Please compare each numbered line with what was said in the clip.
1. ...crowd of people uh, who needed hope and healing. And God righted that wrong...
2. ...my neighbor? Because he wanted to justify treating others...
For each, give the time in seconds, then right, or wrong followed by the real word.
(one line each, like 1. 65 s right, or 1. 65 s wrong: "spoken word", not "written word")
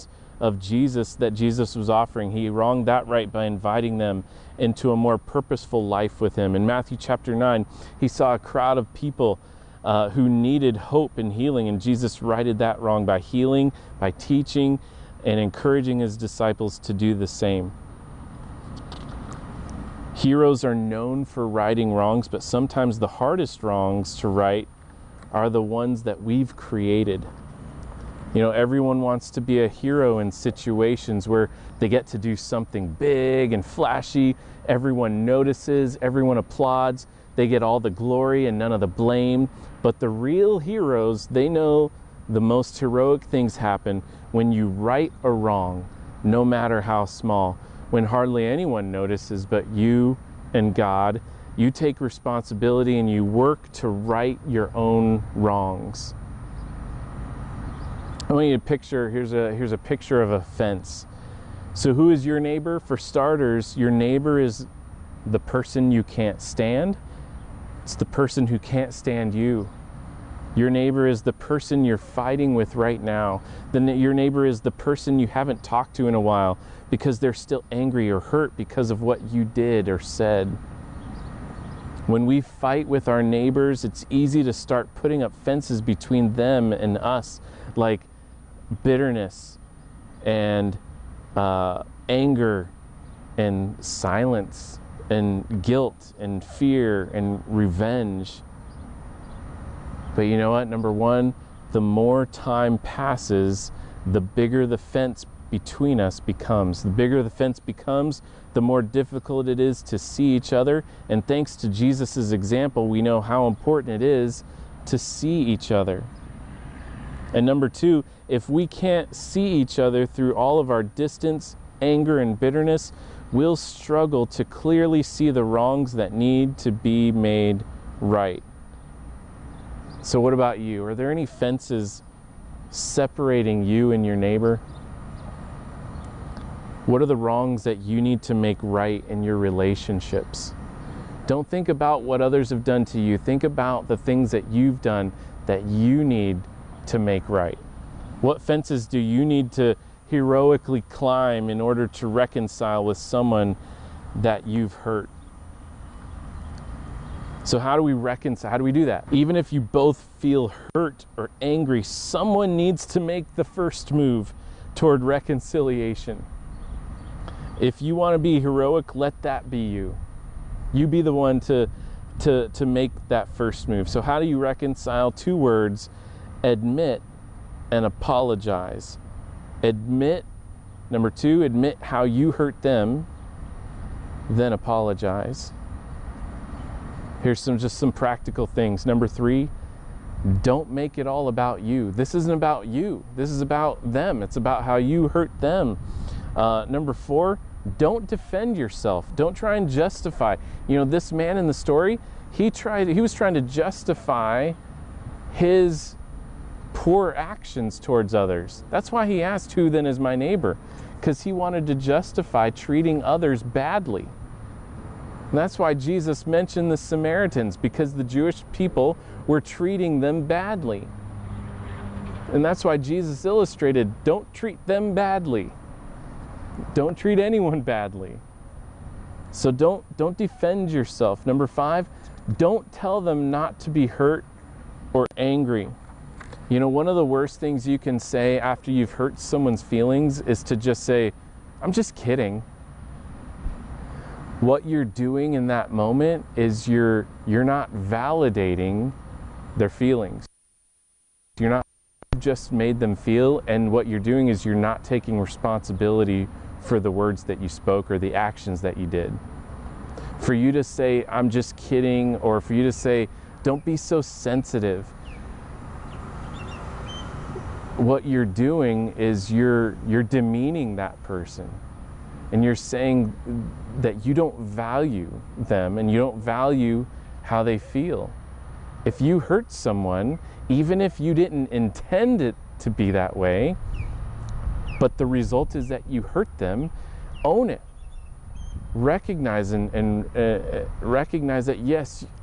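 1. 8 s wrong: "Jesus", not "God"
2. 209 s right.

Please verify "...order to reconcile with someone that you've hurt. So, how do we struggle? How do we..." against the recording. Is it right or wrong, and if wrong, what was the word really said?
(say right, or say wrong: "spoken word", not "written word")
wrong: "reconcile", not "struggle".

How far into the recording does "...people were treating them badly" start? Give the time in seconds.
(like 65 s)
218 s.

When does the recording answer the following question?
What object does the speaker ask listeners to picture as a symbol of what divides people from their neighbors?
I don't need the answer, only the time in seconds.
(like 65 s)
60 s.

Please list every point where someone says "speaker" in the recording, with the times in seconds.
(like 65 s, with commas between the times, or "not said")
not said.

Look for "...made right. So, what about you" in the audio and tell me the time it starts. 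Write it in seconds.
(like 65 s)
127 s.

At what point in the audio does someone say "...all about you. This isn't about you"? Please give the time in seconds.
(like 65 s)
191 s.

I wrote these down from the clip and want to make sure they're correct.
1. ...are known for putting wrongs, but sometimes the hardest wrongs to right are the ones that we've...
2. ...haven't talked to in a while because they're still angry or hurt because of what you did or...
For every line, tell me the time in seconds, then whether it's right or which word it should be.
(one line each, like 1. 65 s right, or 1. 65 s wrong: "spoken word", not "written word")
1. 20 s wrong: "righting", not "putting"
2. 75 s right.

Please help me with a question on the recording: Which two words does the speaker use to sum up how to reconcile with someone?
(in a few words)
Admit and apologize.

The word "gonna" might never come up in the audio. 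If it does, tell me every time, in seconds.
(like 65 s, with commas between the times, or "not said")
not said.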